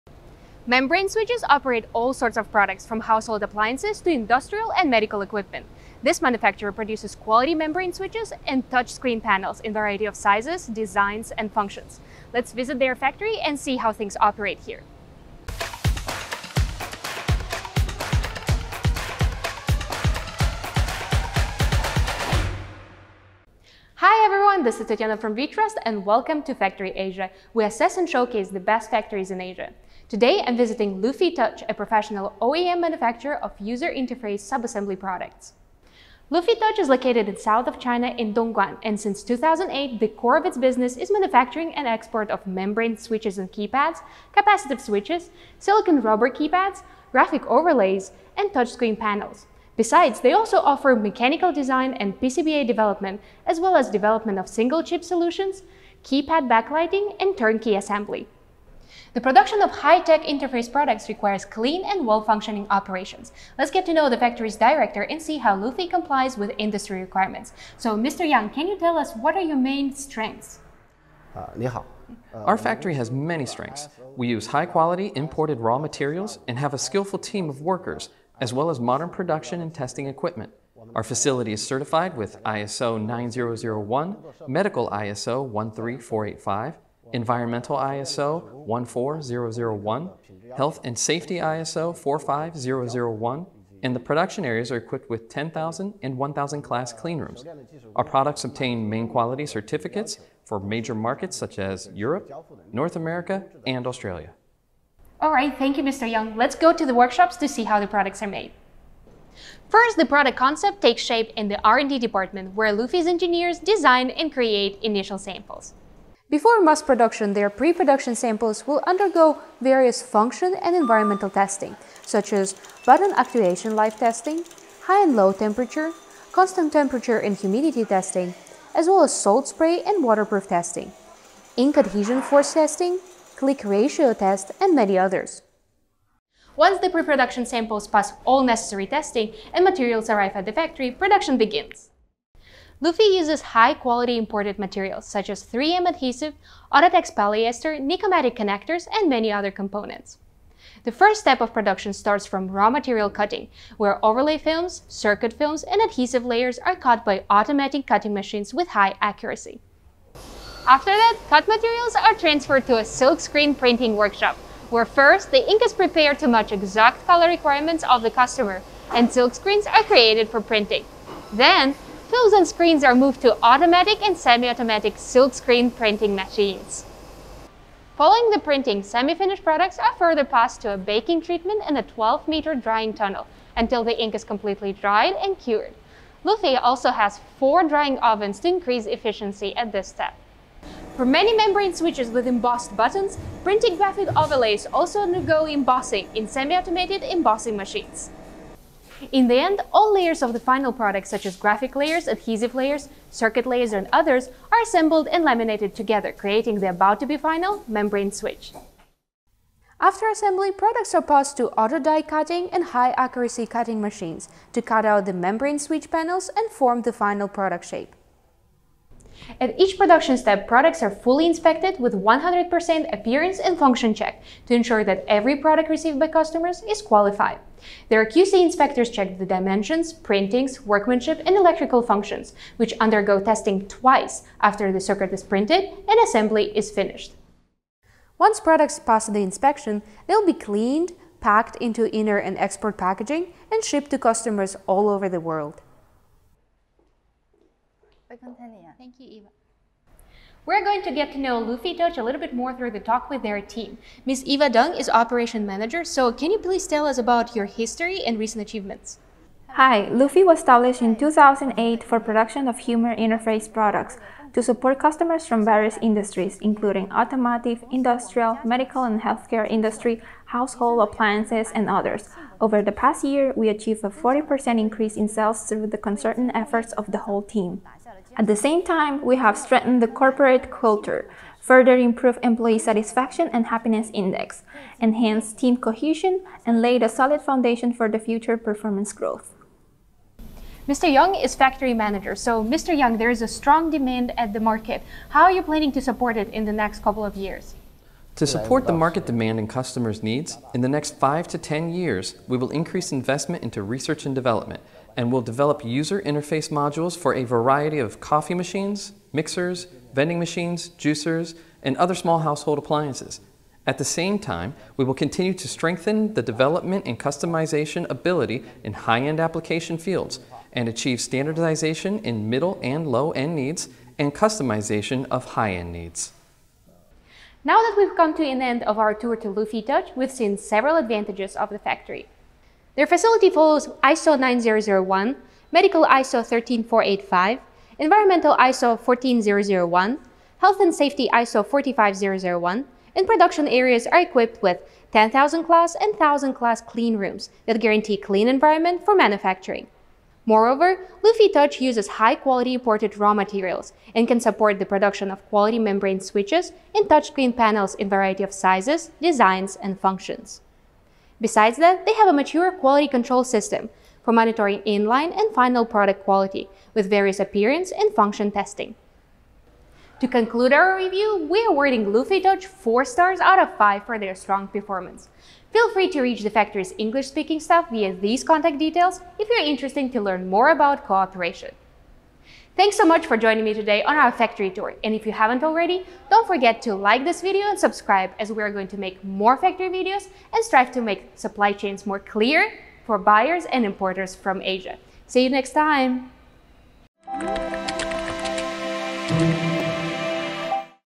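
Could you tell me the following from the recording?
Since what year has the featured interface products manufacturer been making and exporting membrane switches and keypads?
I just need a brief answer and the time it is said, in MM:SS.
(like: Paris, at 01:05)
2008, at 00:38.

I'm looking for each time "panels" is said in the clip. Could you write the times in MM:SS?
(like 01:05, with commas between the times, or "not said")
00:09, 00:48, 03:35, 05:57.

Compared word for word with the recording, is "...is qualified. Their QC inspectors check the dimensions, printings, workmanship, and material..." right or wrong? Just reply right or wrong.
wrong.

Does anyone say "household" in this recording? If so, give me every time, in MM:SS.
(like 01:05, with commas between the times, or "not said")
00:02, 04:30, 05:12.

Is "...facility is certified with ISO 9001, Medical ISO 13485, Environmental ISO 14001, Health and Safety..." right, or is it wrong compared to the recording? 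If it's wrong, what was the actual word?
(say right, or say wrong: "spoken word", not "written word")
right.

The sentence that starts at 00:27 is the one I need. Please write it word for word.
We assess and showcase the best factories in Asia.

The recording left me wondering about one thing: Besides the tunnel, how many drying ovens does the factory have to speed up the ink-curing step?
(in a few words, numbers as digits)
4.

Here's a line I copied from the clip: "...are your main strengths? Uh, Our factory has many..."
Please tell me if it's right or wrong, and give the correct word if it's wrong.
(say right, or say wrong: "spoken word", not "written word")
right.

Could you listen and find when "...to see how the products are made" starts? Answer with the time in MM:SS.
01:47.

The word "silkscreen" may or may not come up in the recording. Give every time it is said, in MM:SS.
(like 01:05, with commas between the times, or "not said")
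02:42, 02:49, 02:54.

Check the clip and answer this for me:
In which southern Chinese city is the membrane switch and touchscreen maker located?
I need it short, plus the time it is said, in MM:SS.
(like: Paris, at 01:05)
Dongguan, at 00:38.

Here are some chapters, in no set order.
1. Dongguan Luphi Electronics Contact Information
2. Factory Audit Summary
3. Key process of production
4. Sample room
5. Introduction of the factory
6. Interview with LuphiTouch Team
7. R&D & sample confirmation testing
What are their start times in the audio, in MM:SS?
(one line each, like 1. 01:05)
1. 06:18
2. 05:28
3. 02:16
4. 00:37
5. 00:24
6. 04:11
7. 01:50.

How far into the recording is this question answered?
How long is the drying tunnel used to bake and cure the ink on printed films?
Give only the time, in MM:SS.
03:01.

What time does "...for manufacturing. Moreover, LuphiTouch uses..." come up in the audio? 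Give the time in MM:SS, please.
05:48.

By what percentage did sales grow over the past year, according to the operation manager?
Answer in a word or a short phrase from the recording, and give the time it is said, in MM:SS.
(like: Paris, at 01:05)
40%, at 04:33.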